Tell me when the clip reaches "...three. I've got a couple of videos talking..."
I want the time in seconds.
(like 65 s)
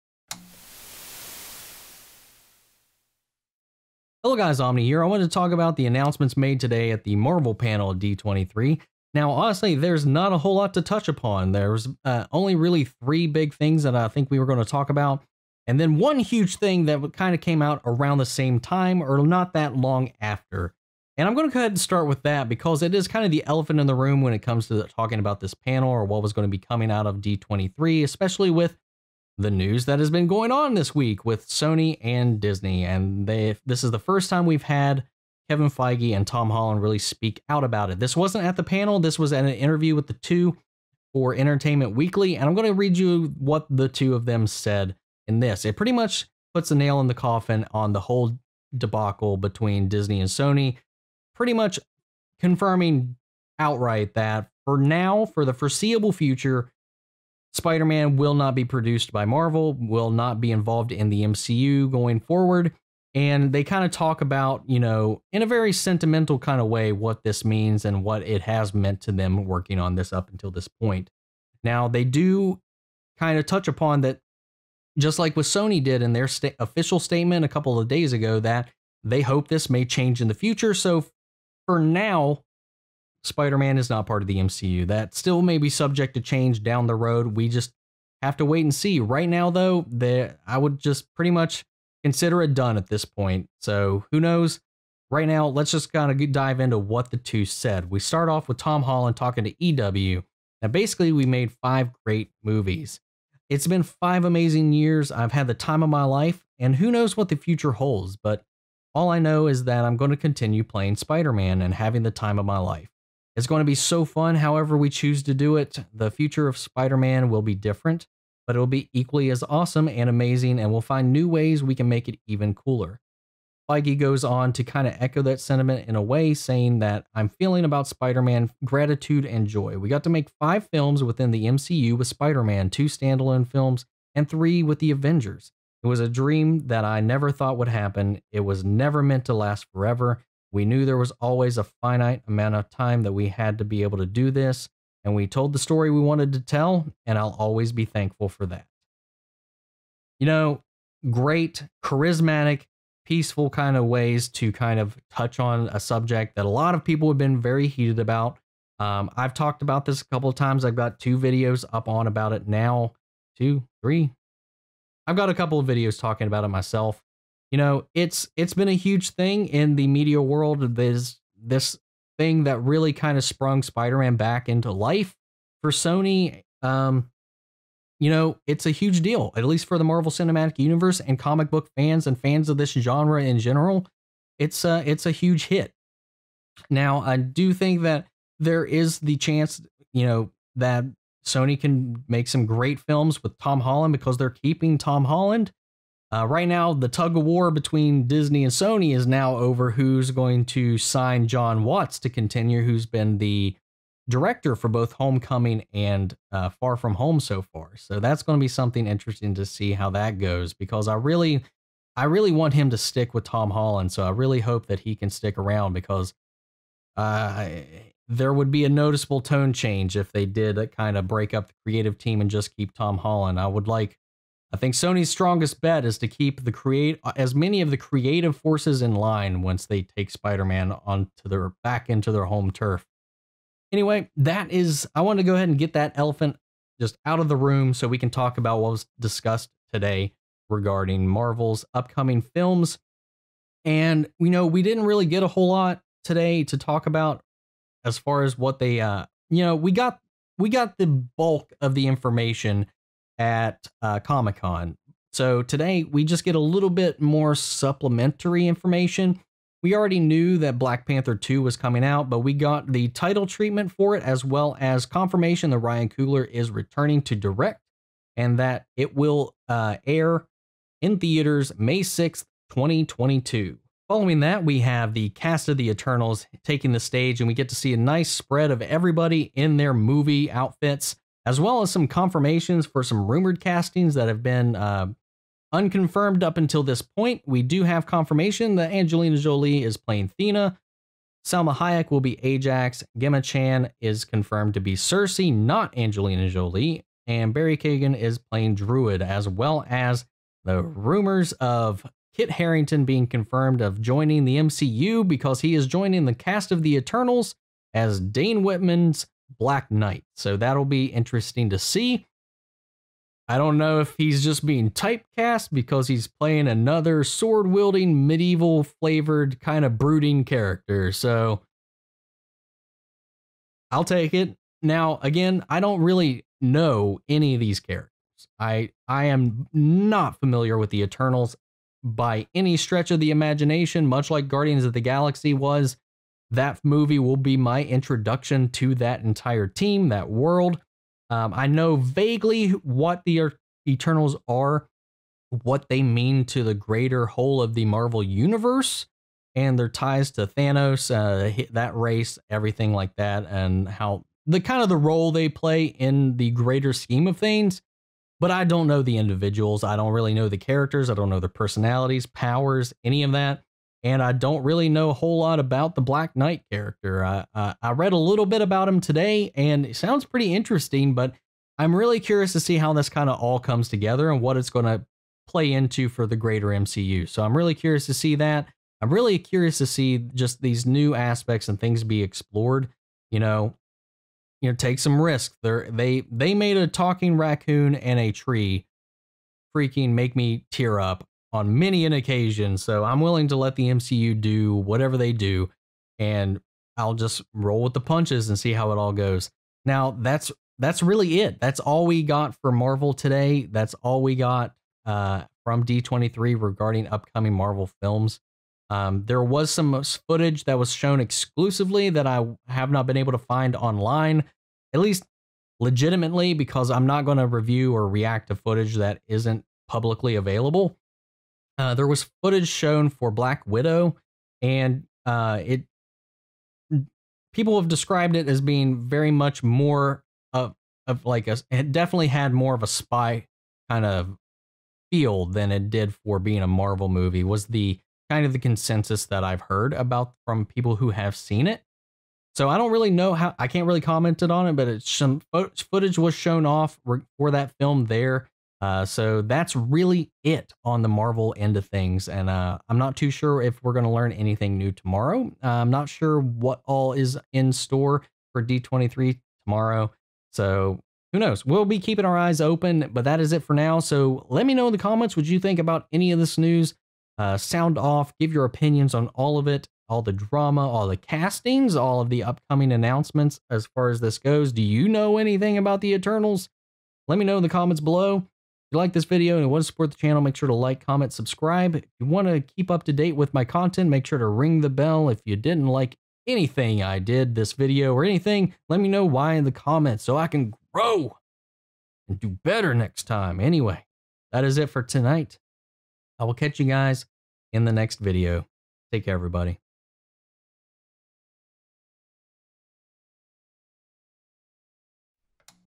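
163 s.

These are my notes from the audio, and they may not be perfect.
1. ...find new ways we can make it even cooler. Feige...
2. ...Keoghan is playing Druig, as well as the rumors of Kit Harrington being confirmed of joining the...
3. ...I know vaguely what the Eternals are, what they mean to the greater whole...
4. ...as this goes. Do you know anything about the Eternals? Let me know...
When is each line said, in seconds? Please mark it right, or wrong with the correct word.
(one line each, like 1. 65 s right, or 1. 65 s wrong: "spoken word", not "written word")
1. 120 s right
2. 297 s right
3. 341 s right
4. 473 s right.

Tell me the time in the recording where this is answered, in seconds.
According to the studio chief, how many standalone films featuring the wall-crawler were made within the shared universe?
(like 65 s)
132 s.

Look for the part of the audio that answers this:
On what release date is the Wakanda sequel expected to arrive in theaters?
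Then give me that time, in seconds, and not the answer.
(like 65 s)
271 s.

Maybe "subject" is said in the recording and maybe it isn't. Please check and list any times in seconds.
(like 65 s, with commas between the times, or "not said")
85 s, 155 s.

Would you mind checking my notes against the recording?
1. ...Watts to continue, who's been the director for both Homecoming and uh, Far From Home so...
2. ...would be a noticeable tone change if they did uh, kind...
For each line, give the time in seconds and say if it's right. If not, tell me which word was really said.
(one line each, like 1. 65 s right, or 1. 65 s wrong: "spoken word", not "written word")
1. 201 s right
2. 218 s right.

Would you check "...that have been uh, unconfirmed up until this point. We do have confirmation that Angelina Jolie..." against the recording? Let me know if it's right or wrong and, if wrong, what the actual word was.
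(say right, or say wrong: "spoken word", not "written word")
right.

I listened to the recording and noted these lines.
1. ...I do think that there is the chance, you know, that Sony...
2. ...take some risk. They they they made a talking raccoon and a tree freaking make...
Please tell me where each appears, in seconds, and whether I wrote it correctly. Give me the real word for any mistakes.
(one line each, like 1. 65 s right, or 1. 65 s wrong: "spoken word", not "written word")
1. 187 s right
2. 384 s right.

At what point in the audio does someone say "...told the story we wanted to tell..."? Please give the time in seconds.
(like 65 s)
145 s.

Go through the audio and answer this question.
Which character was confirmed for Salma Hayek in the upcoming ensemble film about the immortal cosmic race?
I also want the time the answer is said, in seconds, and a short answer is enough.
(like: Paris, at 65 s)
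Ajax, at 292 s.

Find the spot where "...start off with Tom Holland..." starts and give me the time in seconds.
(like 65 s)
97 s.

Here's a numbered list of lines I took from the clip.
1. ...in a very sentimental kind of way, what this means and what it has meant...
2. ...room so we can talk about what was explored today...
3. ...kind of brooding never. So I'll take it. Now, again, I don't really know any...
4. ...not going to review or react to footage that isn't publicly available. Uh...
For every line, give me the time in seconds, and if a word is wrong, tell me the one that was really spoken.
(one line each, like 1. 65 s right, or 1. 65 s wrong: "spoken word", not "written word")
1. 65 s right
2. 237 s wrong: "discussed", not "explored"
3. 319 s wrong: "character", not "never"
4. 416 s right.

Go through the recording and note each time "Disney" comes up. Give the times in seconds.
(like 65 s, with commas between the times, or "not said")
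32 s, 49 s, 198 s.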